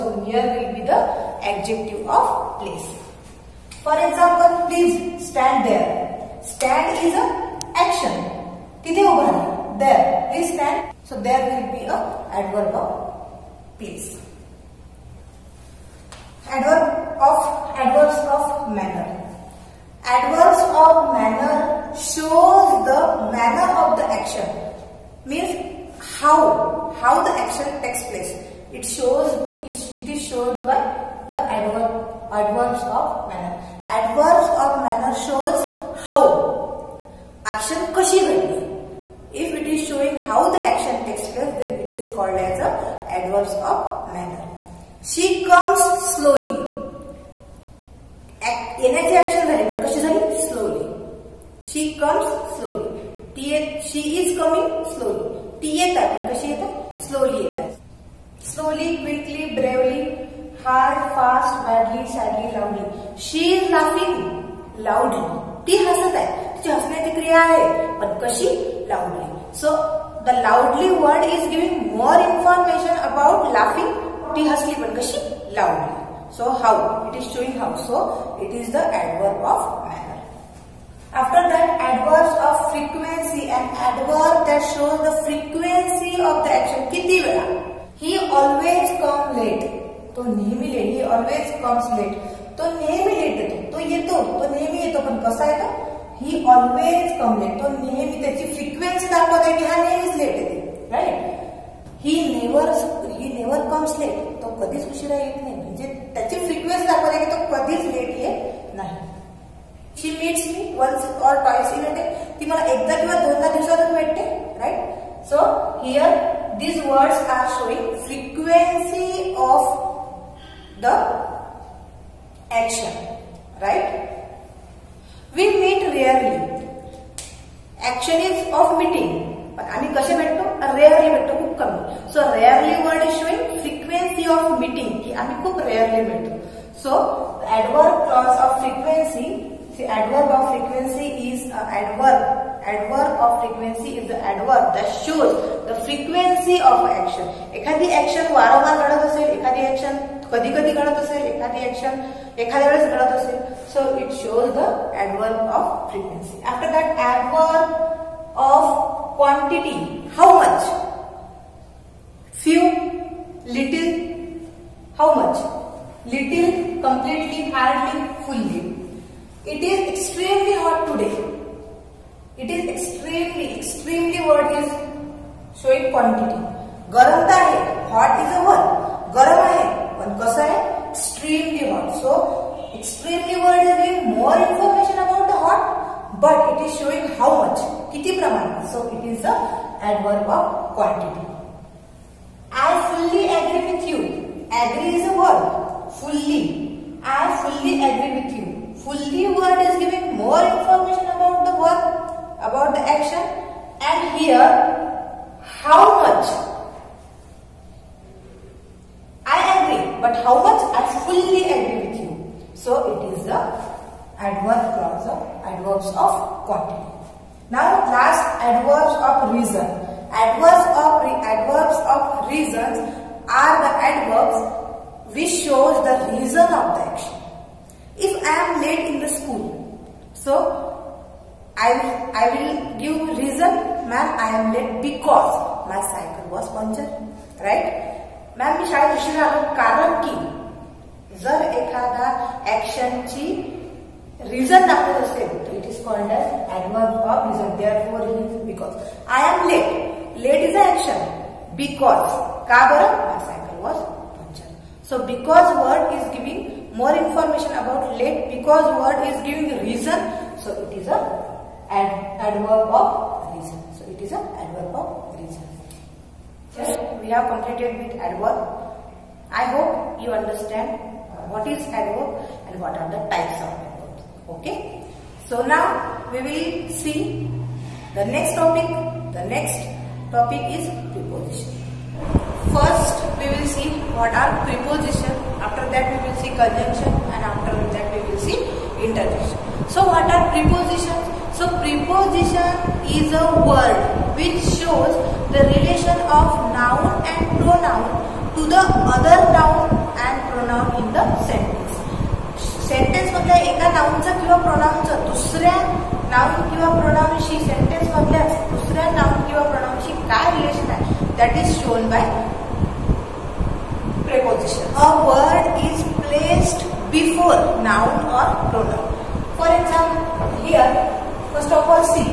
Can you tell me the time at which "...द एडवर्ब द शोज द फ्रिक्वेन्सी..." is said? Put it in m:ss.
2:24.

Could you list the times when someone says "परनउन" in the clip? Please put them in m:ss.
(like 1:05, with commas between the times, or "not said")
5:18.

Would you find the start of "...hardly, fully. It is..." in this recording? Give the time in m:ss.
2:47.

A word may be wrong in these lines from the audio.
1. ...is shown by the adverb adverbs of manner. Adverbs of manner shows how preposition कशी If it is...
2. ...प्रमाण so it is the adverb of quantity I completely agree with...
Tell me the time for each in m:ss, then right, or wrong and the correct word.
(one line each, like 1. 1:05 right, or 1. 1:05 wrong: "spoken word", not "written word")
1. 0:30 wrong: "action", not "preposition"
2. 3:08 wrong: "fully", not "completely".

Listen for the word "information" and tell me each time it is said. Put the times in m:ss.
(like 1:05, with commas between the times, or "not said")
3:20, 4:16.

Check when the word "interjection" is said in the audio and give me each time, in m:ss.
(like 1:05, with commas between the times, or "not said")
4:48.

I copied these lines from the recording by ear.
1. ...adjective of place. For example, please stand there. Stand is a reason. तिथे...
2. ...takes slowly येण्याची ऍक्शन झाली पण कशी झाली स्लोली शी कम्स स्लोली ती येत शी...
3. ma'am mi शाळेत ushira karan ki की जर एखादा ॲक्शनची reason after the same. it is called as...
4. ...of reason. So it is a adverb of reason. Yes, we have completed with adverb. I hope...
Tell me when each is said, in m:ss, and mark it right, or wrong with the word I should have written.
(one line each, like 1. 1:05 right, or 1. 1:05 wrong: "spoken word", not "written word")
1. 0:01 wrong: "action", not "reason"
2. 0:45 wrong: "comes", not "takes"
3. 3:58 right
4. 4:22 right.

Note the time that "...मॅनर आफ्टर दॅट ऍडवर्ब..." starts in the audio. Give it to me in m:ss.
1:19.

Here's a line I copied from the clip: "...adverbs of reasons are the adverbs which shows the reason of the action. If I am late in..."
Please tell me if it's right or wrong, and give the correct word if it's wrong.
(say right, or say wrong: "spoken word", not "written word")
right.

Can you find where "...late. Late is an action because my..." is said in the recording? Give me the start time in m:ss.
4:09.